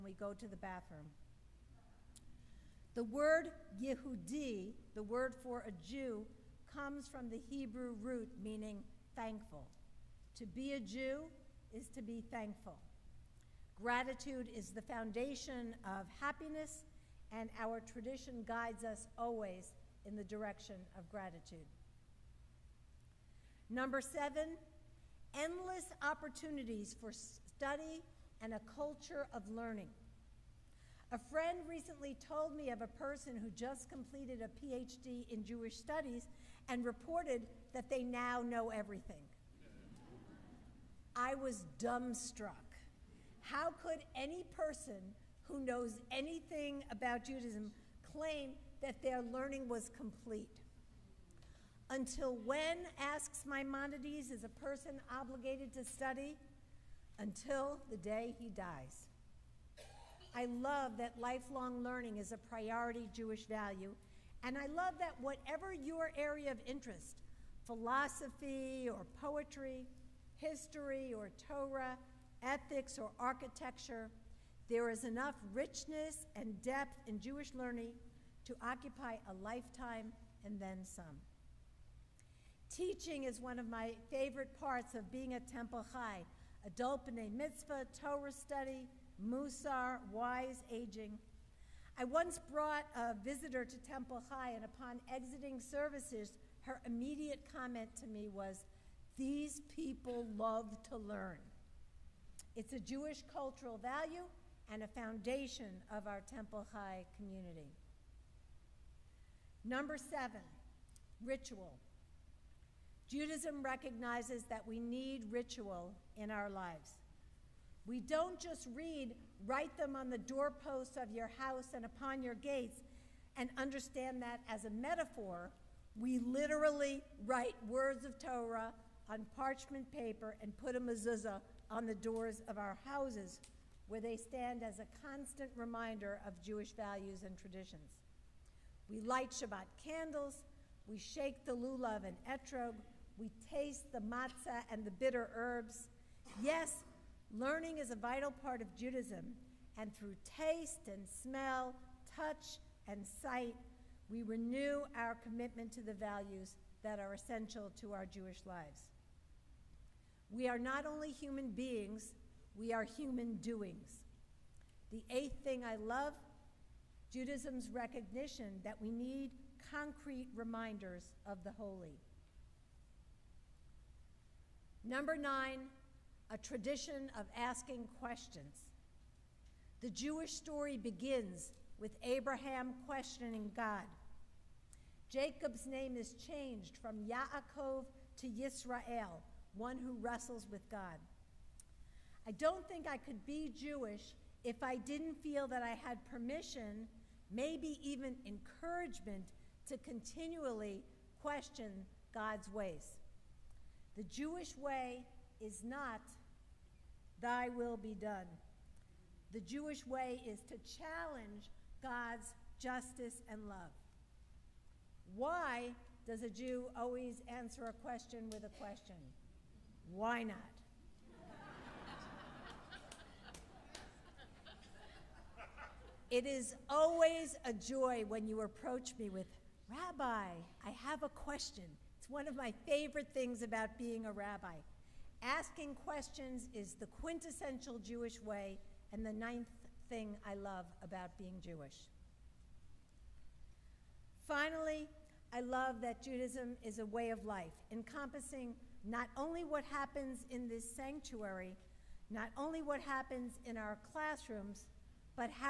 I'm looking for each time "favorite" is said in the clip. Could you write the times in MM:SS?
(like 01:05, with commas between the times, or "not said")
01:24, 03:52.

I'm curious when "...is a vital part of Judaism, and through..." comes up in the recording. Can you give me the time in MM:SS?
02:27.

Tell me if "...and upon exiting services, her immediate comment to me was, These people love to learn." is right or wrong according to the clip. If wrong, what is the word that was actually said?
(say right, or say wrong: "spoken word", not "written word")
right.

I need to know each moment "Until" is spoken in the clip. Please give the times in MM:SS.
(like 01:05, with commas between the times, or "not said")
00:51, 00:57.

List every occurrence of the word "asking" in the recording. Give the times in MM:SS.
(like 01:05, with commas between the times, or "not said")
02:57, 03:55.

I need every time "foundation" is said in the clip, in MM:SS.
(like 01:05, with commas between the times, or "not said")
00:14, 01:44.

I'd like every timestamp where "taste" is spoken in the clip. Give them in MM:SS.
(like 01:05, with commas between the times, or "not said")
02:23, 02:30.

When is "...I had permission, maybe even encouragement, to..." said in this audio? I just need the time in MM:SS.
03:15.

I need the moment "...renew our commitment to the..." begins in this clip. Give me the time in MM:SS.
02:34.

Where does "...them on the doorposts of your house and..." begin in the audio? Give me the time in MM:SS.
01:59.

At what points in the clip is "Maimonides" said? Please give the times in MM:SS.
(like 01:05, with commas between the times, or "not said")
00:53.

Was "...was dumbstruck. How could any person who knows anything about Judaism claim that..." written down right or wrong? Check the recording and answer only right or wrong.
right.